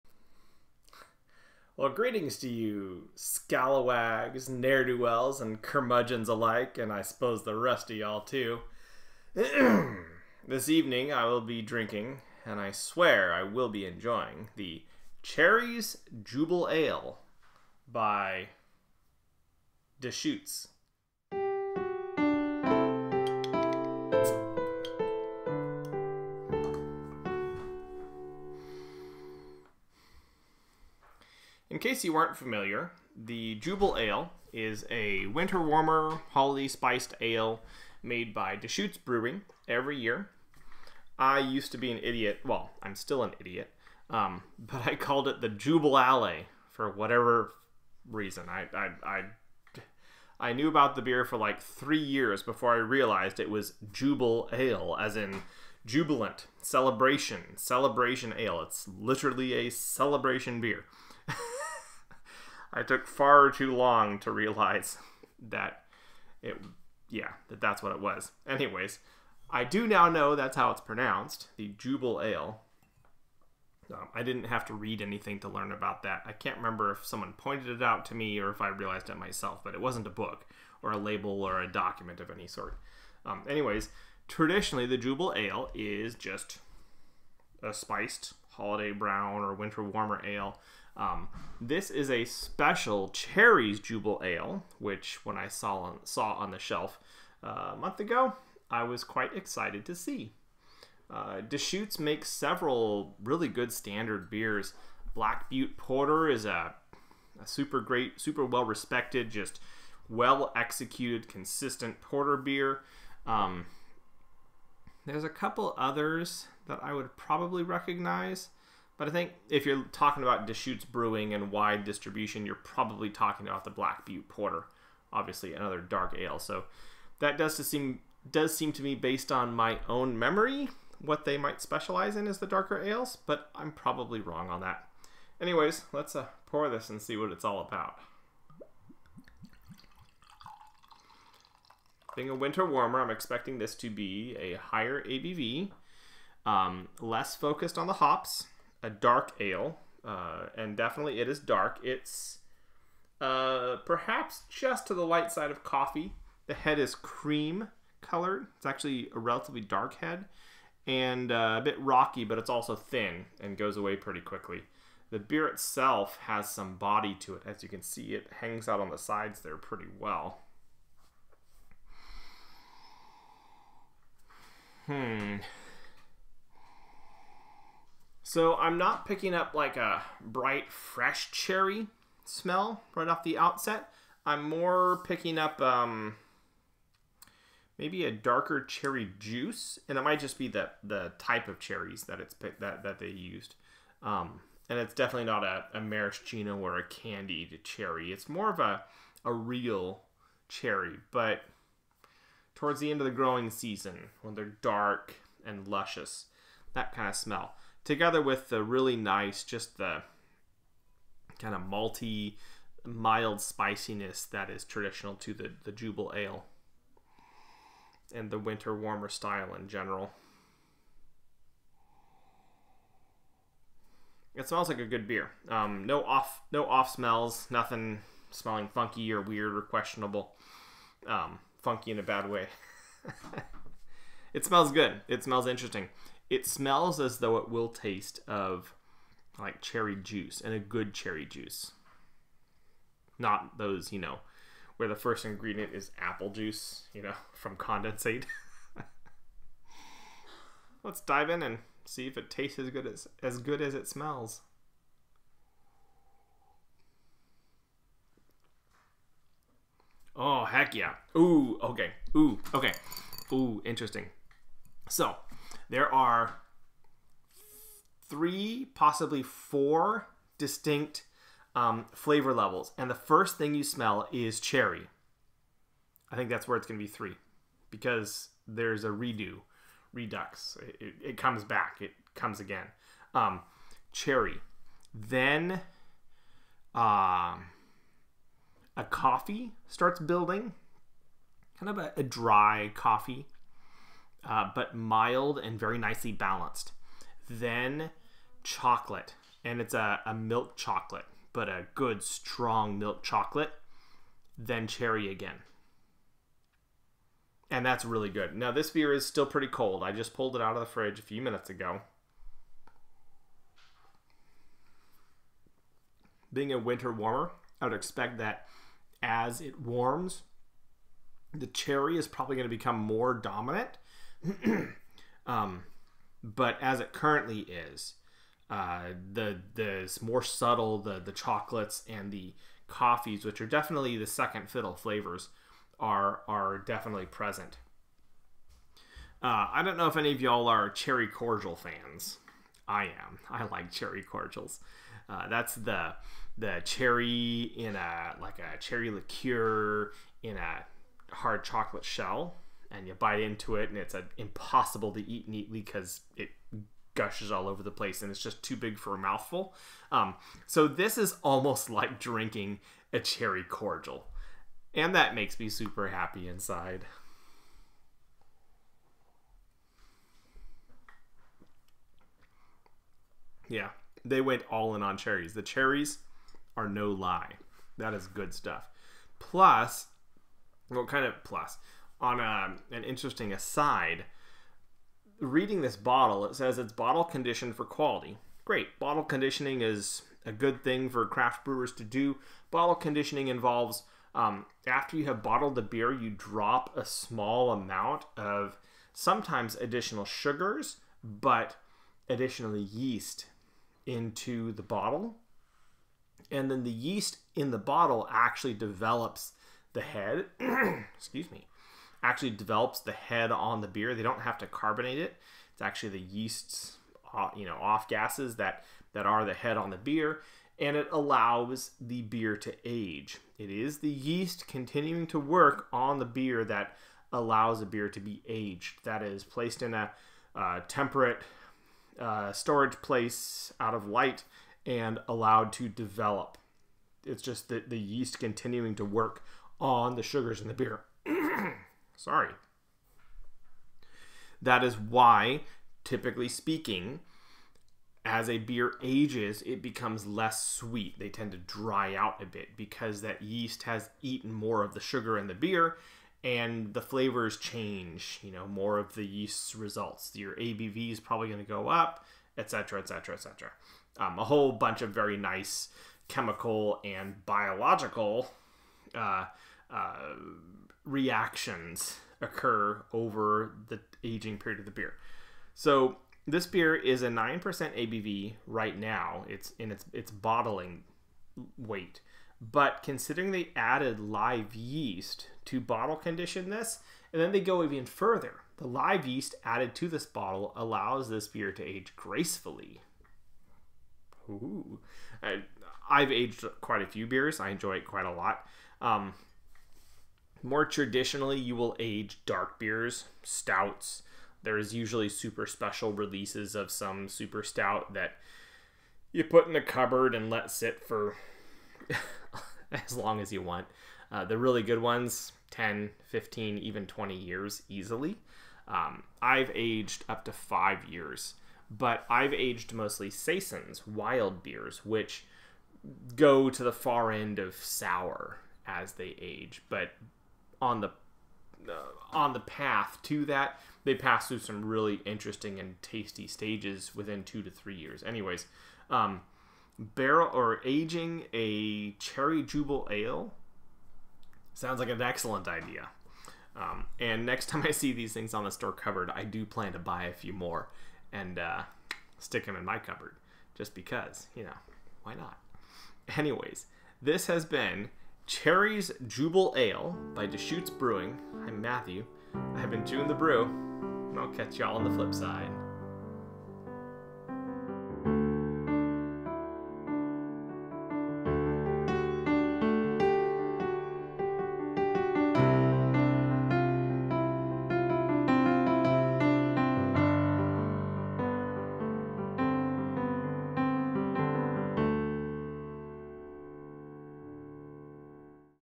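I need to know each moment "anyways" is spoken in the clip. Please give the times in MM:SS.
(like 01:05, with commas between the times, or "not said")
01:08, 01:23, 02:15, 08:58, 09:16.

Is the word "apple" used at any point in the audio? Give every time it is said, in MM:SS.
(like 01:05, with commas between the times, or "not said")
04:05.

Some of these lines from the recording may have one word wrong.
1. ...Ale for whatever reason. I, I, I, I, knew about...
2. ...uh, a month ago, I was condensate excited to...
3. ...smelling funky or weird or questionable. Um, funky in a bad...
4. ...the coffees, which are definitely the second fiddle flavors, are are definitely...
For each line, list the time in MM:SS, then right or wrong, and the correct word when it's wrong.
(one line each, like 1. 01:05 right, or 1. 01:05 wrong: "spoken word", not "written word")
1. 00:45 right
2. 01:37 wrong: "quite", not "condensate"
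3. 03:48 right
4. 05:32 right.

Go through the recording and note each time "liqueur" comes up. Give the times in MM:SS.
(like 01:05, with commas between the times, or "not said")
05:48.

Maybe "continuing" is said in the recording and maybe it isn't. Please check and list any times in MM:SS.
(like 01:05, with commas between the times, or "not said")
07:04, 07:18.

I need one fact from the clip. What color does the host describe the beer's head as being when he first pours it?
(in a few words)
Cream colored.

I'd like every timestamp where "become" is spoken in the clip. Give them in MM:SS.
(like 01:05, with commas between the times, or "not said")
05:22, 07:29.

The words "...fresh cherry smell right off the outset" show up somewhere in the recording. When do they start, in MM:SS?
03:00.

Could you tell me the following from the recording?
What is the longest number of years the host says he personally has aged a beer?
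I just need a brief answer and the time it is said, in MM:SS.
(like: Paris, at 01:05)
5 years, at 08:40.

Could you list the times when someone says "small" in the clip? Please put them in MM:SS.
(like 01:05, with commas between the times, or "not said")
06:36.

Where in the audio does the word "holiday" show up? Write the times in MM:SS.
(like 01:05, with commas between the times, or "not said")
00:36, 01:28.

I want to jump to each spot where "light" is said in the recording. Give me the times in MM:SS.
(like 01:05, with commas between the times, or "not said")
02:35, 07:13.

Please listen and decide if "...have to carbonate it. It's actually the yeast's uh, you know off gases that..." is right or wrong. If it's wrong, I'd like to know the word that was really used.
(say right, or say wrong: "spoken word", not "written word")
right.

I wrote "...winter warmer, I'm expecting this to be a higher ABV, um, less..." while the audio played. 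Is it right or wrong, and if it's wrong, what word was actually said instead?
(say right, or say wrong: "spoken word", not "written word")
right.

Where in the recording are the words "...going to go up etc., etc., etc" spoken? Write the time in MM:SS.
07:41.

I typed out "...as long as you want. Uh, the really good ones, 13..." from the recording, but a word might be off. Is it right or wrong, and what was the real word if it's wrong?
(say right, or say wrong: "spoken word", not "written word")
wrong: "10", not "13".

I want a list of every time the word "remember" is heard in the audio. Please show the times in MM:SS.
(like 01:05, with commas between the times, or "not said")
01:16.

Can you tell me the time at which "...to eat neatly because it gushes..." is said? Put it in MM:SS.
05:54.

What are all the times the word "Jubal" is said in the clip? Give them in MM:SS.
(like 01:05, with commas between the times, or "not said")
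00:16, 00:45.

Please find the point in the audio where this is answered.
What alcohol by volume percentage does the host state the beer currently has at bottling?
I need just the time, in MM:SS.
07:57.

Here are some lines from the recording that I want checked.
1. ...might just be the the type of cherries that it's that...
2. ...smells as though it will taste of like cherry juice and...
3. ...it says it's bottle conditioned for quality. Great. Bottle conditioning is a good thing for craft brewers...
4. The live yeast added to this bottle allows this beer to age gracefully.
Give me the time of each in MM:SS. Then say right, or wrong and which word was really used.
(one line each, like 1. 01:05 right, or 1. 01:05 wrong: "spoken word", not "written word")
1. 03:10 right
2. 03:56 right
3. 06:26 right
4. 08:08 right.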